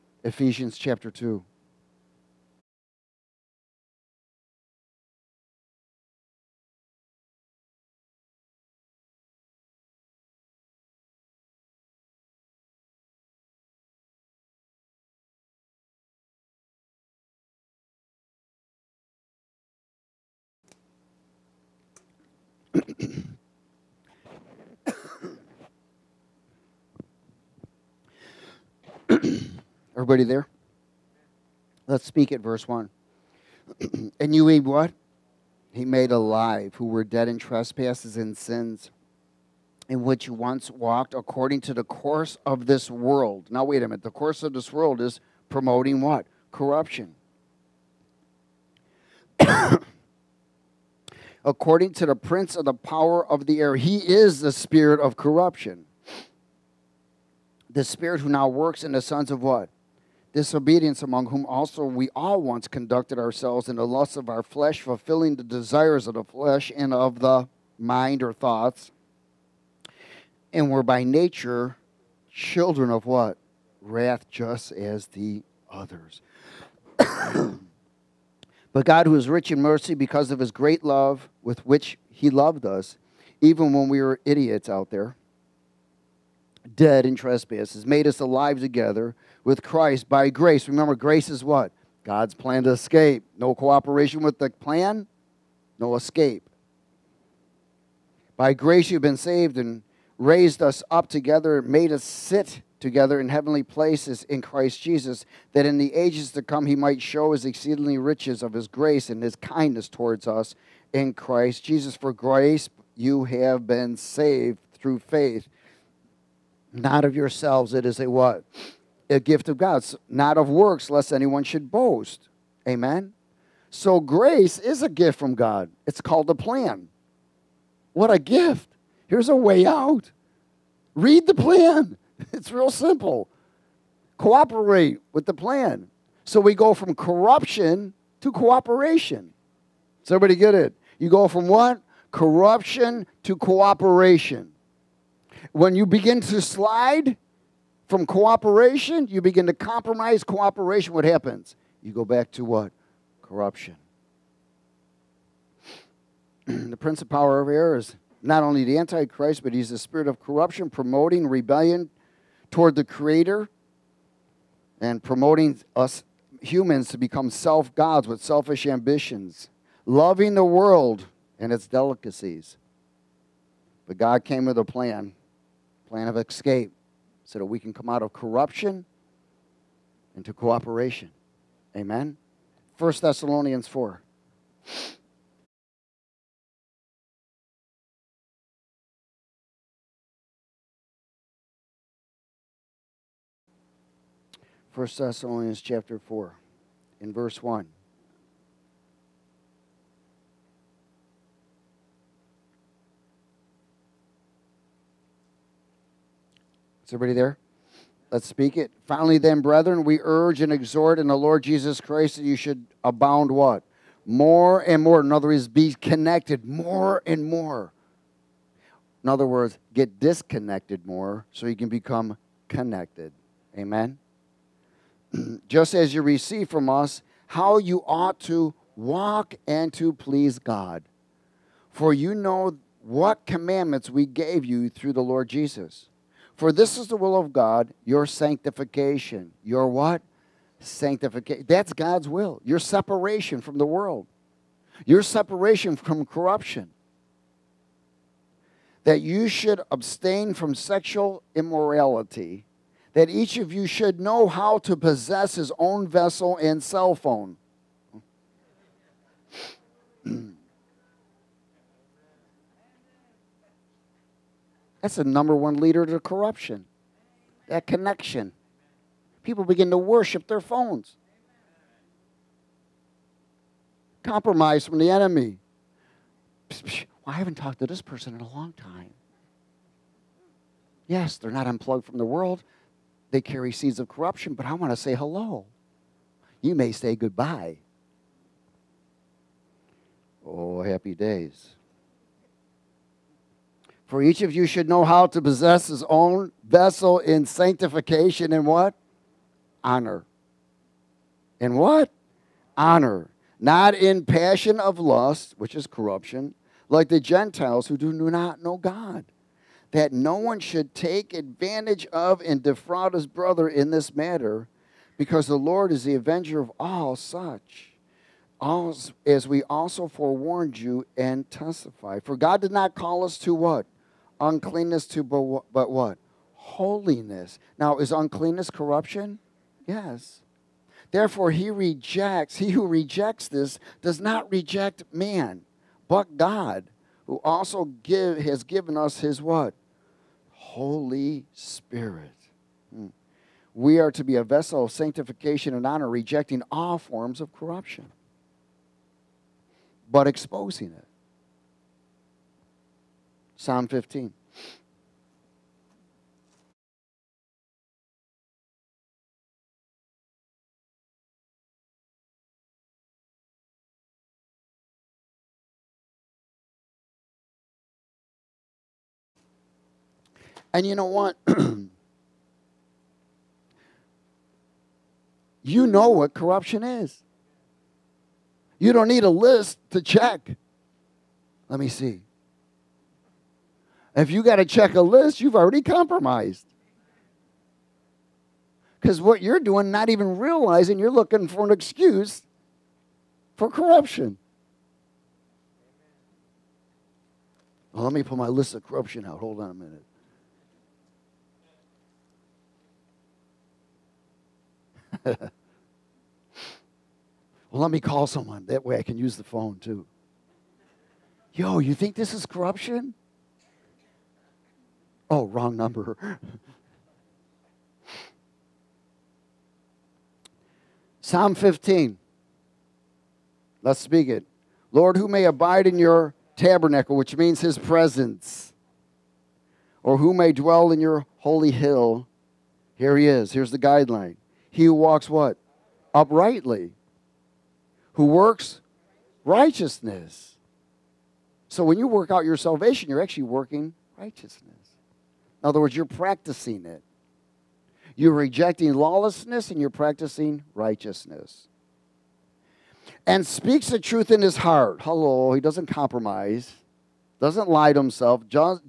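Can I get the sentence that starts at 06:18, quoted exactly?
You don't need a list to check.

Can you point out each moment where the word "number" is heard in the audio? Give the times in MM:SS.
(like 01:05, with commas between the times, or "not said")
04:25, 06:55.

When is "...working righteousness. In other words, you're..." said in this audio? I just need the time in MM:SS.
07:23.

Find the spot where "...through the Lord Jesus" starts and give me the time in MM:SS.
03:54.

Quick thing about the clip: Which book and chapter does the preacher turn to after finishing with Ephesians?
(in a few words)
1 Thessalonians 4.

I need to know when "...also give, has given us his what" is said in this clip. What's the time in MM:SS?
05:37.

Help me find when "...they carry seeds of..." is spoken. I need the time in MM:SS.
04:43.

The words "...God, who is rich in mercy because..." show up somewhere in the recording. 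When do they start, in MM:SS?
01:18.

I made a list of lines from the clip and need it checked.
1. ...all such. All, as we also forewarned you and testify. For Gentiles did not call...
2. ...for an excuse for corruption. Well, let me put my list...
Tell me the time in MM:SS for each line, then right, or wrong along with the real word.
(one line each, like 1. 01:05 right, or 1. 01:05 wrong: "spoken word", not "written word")
1. 05:16 wrong: "God", not "Gentiles"
2. 06:31 right.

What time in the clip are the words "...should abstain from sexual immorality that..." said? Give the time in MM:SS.
04:09.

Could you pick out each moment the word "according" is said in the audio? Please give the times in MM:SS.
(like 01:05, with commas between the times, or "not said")
00:41, 00:51.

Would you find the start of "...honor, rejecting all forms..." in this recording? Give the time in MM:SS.
05:45.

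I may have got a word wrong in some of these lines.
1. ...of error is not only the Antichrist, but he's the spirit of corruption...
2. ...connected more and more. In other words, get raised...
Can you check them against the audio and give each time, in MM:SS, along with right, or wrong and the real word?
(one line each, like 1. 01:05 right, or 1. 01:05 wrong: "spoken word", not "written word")
1. 02:37 right
2. 03:35 wrong: "disconnected", not "raised".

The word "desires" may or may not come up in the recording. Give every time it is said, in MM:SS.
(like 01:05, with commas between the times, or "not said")
01:05.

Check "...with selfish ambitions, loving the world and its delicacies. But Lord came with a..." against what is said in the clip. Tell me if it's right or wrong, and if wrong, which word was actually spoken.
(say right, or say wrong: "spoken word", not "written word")
wrong: "God", not "Lord".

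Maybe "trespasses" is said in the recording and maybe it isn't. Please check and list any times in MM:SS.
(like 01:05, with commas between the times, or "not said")
00:37, 01:27.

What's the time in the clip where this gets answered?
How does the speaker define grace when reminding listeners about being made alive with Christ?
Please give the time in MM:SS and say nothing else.
01:32.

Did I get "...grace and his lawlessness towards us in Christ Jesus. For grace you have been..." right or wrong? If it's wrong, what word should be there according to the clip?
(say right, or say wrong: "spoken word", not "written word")
wrong: "kindness", not "lawlessness".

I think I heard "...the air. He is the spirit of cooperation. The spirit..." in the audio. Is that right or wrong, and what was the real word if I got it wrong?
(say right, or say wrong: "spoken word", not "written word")
wrong: "corruption", not "cooperation".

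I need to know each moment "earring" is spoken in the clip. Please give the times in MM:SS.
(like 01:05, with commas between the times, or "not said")
not said.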